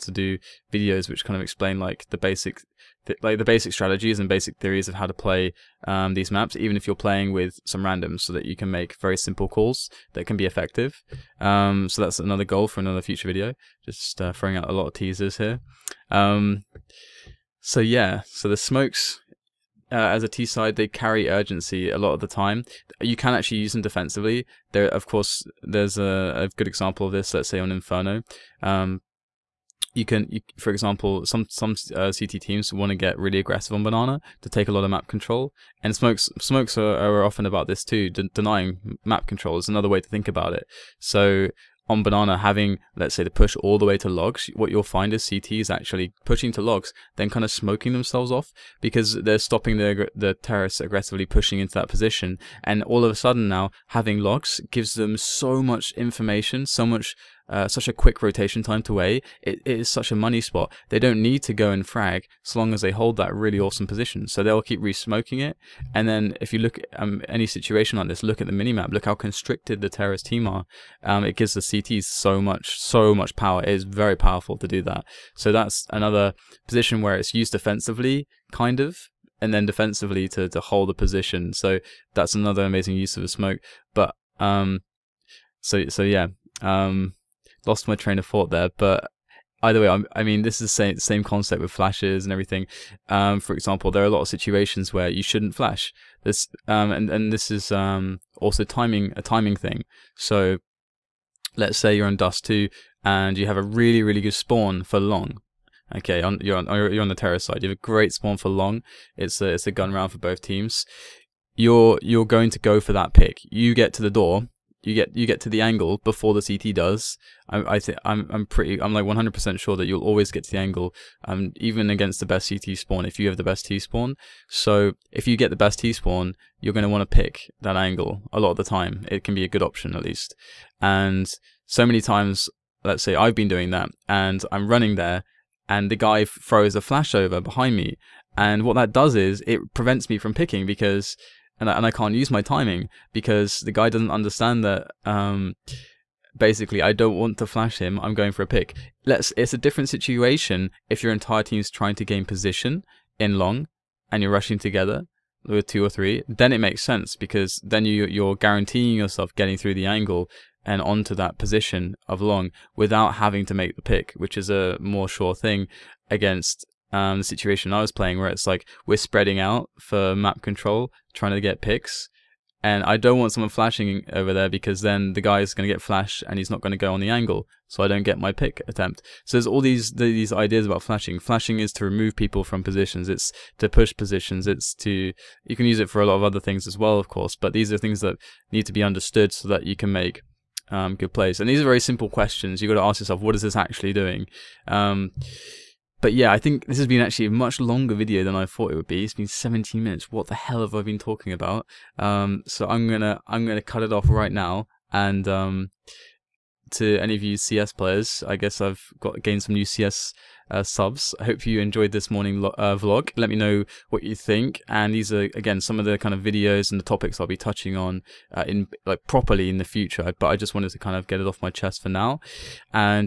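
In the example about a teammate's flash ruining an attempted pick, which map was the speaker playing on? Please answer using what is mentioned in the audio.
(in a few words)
Dust Two.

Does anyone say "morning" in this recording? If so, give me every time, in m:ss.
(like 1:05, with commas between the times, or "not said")
3:32.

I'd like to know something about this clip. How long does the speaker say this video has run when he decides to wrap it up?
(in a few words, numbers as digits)
17 minutes.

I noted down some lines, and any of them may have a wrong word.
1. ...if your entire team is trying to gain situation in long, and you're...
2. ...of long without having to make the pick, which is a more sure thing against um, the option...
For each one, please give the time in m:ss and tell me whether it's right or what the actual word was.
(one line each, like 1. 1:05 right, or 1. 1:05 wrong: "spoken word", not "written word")
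1. 2:30 wrong: "position", not "situation"
2. 2:42 wrong: "situation", not "option".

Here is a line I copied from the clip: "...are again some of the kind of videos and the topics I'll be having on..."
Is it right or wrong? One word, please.
wrong.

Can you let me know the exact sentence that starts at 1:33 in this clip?
Um, for example, there are a lot of situations where you shouldn't flash.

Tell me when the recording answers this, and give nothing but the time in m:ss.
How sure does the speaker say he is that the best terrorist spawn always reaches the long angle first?
1:59.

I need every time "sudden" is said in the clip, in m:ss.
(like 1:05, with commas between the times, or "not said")
0:53.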